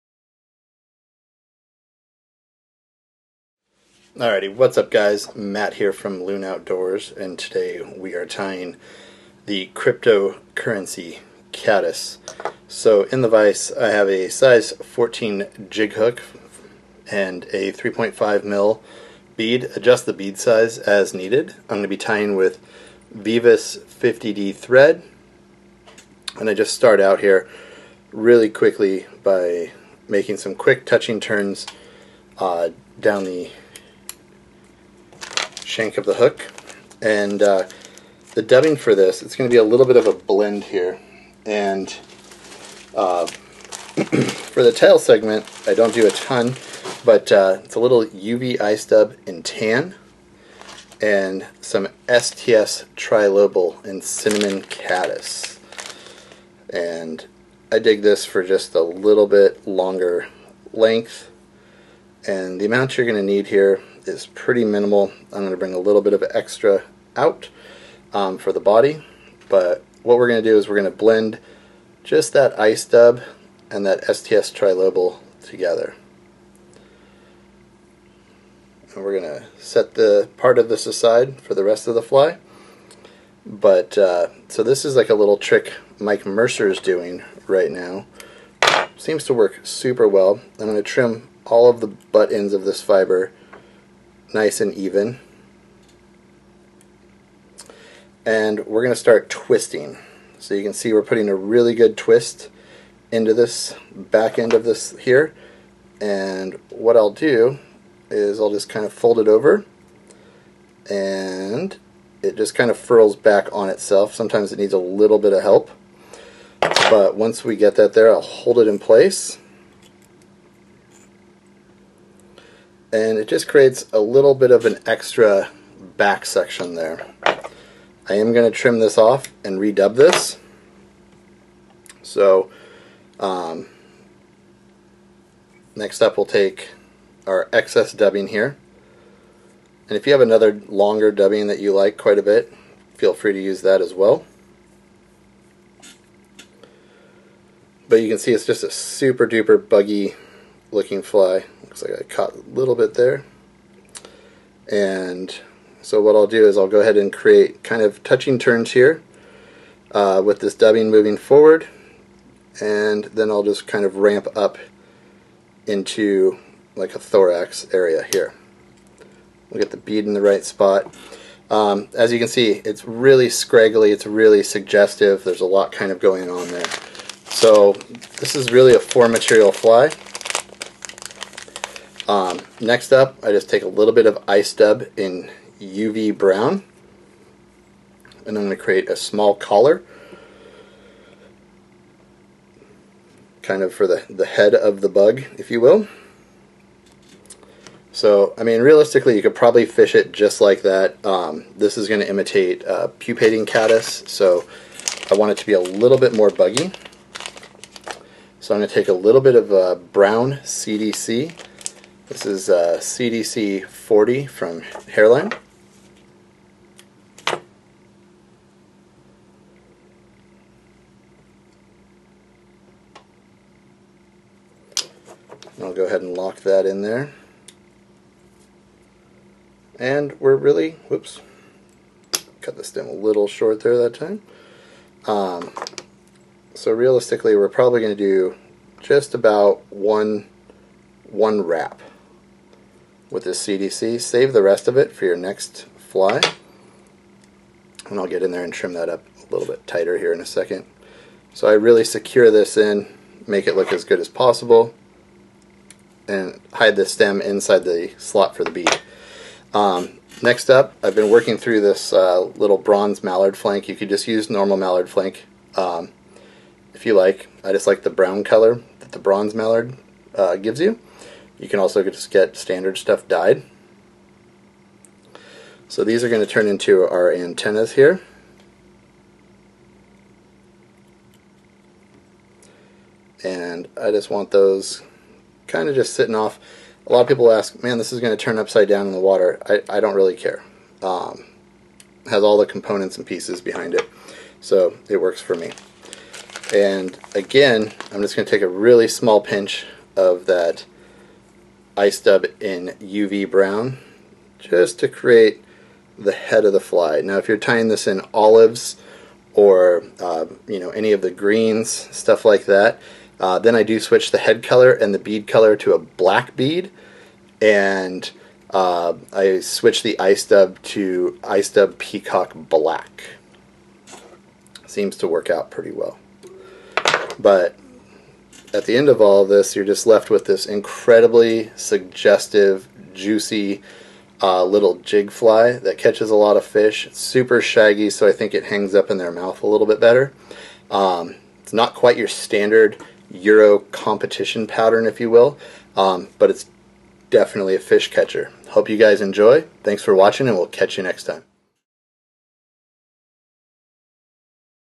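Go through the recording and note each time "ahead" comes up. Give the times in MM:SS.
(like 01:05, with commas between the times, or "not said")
02:36, 03:45.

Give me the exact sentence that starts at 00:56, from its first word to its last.
And I dig this for just a little bit longer length.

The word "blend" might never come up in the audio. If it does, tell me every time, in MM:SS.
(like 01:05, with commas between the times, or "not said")
00:40, 01:10.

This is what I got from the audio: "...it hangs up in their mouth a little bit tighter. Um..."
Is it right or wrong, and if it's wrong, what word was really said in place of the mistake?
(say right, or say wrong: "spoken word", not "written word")
wrong: "better", not "tighter".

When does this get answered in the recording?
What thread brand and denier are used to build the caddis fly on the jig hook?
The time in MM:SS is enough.
00:23.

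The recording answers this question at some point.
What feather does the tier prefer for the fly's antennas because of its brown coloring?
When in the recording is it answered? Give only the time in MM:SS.
04:22.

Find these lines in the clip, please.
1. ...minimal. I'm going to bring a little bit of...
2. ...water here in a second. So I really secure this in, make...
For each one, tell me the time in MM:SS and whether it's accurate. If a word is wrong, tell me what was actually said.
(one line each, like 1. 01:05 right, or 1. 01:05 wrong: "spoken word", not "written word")
1. 01:04 right
2. 04:09 wrong: "tighter", not "water".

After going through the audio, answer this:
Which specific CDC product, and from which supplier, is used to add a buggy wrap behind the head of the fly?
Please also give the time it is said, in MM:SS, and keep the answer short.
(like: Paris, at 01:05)
CDC 40 from Hareline, at 03:32.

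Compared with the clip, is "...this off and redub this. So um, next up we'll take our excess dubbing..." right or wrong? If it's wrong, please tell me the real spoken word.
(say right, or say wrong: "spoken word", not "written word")
right.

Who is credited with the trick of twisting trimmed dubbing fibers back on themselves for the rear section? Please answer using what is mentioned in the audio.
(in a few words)
Mike Mercer.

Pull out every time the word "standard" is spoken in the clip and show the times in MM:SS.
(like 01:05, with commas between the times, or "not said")
04:32, 05:42.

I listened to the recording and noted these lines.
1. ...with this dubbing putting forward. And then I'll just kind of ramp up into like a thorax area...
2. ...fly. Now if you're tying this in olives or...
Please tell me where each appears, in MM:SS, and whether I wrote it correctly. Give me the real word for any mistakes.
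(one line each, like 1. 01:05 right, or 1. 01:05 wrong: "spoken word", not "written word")
1. 02:40 wrong: "moving", not "putting"
2. 05:06 right.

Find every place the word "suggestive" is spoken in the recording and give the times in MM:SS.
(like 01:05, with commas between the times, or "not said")
02:54, 05:31.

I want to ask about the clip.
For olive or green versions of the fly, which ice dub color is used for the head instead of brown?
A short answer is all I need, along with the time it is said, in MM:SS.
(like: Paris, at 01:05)
Peacock Black, at 05:21.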